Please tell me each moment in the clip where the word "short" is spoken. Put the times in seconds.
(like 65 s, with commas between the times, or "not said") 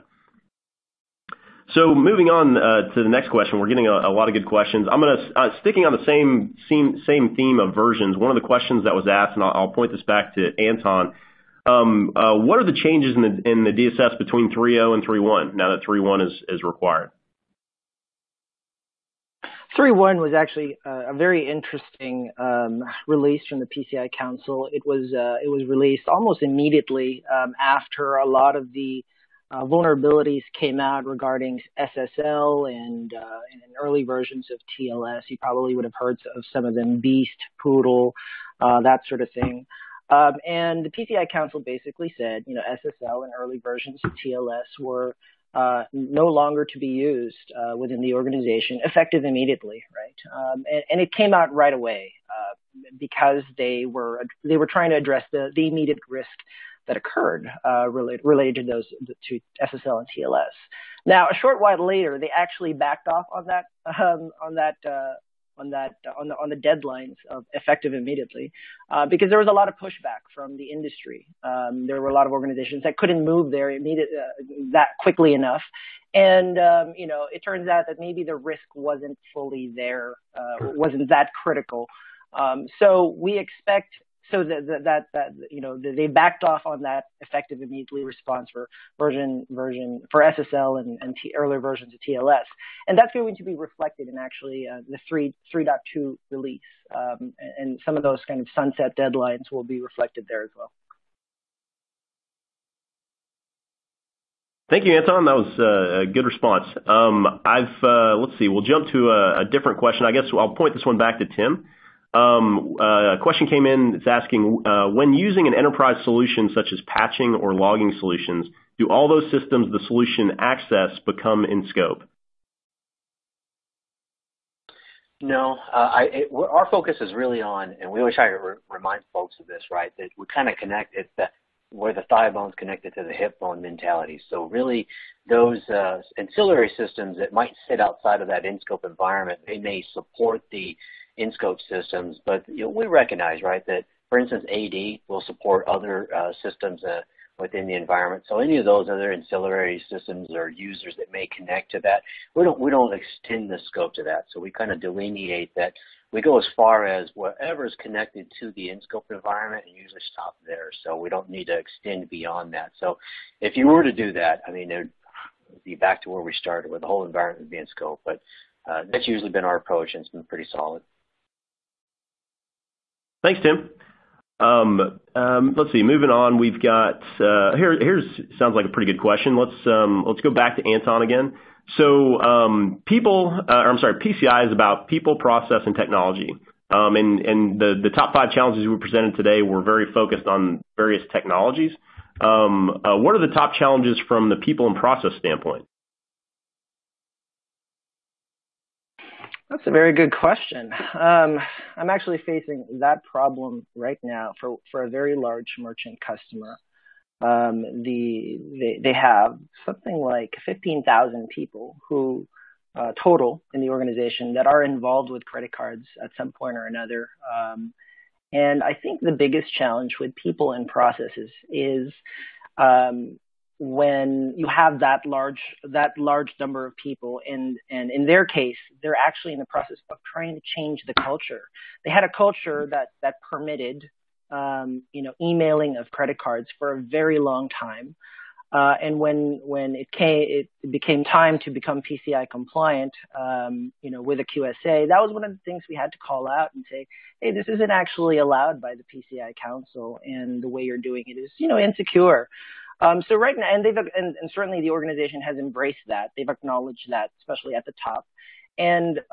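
61 s.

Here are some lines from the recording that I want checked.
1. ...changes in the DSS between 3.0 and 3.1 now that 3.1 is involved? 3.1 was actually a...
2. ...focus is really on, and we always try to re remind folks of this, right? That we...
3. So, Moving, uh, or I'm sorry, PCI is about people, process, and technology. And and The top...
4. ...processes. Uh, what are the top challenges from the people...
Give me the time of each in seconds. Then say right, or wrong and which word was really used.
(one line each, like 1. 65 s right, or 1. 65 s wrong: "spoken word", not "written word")
1. 12 s wrong: "required", not "involved"
2. 126 s right
3. 181 s wrong: "People", not "Moving"
4. 191 s wrong: "technologies", not "processes".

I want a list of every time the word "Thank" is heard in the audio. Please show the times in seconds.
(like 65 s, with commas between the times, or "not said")
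104 s, 173 s.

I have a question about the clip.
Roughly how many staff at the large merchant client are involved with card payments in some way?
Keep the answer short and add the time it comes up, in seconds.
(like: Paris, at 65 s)
15,000, at 210 s.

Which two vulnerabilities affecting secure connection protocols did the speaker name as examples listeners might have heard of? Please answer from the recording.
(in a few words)
Beast, Poodle.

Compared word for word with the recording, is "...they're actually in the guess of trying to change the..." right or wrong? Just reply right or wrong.
wrong.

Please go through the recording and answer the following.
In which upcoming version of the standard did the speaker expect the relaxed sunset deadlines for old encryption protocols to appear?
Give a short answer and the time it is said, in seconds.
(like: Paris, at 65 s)
3.2, at 95 s.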